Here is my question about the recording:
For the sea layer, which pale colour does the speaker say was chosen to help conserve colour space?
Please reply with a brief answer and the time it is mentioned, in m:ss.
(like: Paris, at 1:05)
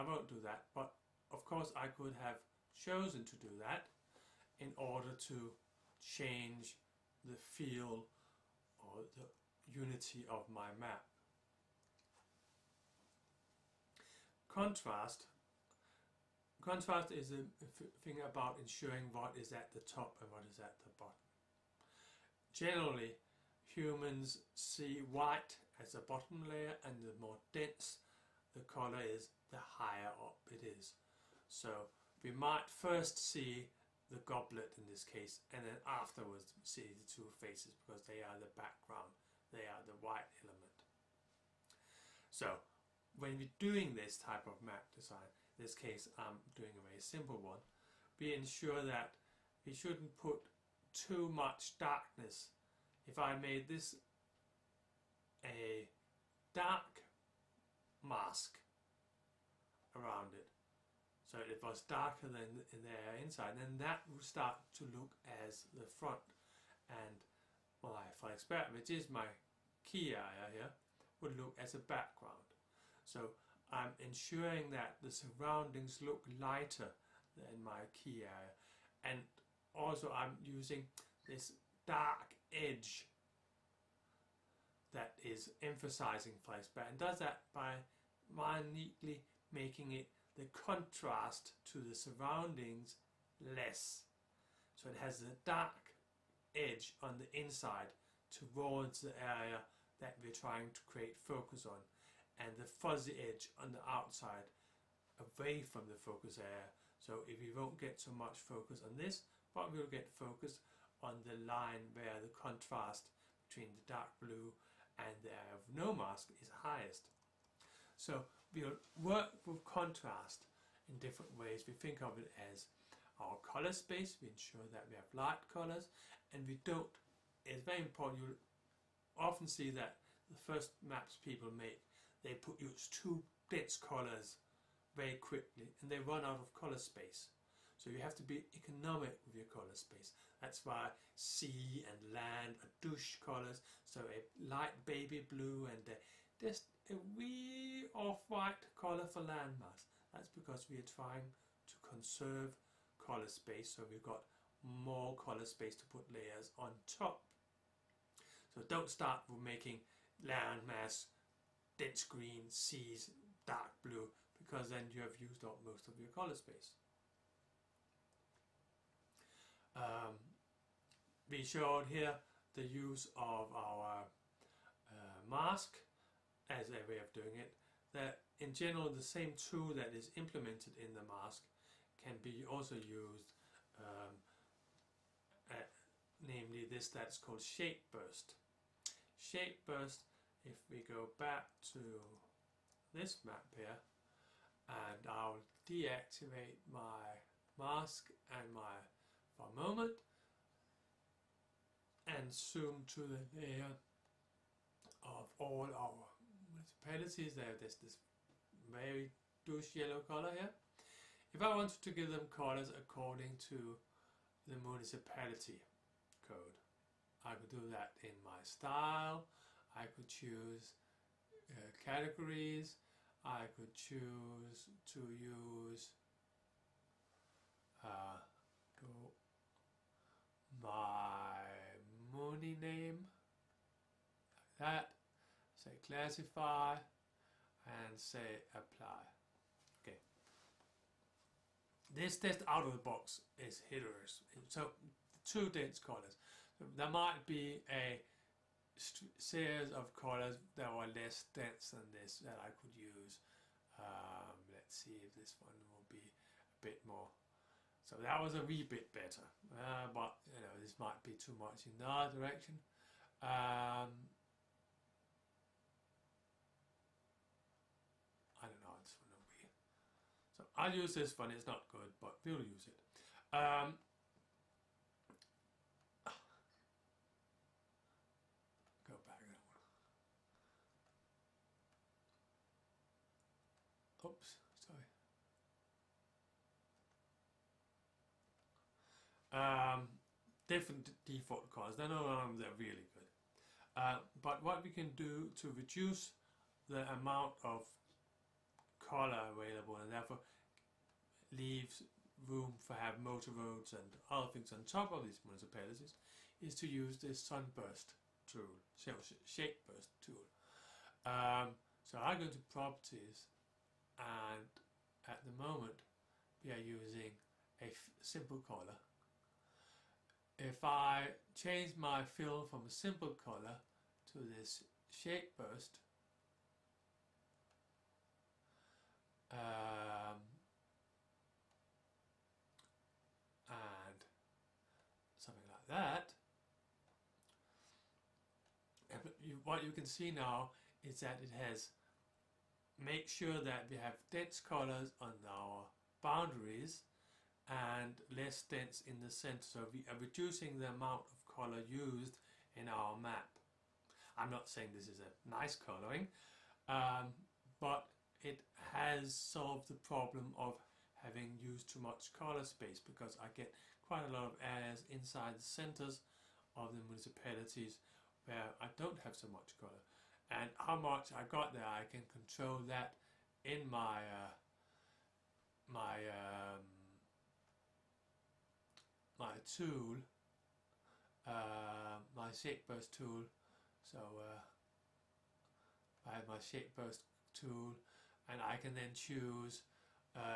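Light baby blue, at 2:24.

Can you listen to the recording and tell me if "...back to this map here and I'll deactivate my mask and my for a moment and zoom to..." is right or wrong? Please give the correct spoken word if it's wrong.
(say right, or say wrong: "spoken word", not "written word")
right.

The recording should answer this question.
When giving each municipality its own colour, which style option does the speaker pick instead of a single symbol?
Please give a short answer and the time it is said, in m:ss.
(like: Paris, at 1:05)
Categories, at 3:41.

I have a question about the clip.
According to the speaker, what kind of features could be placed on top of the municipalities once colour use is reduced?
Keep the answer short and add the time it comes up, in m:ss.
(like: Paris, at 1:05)
Motor roads, at 5:03.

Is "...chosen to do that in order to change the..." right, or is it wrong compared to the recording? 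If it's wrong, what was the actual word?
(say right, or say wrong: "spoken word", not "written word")
right.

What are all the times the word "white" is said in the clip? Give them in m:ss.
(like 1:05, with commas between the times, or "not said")
0:25, 2:27.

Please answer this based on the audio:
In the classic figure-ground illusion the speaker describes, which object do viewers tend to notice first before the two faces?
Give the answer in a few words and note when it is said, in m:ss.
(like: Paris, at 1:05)
The goblet, at 0:34.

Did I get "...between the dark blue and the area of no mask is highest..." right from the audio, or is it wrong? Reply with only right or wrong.
right.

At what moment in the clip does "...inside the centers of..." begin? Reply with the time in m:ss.
6:04.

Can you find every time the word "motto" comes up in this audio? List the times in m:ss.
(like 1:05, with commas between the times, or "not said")
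not said.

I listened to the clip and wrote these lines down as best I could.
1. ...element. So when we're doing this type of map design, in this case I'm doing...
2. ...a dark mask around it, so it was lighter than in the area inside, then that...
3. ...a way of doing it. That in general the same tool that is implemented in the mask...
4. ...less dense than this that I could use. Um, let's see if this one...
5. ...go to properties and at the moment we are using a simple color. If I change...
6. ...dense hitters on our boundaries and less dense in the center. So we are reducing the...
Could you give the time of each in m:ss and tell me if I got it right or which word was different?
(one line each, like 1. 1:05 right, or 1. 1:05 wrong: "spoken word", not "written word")
1. 0:40 right
2. 0:55 wrong: "darker", not "lighter"
3. 2:56 right
4. 4:10 right
5. 5:12 right
6. 5:44 wrong: "colors", not "hitters".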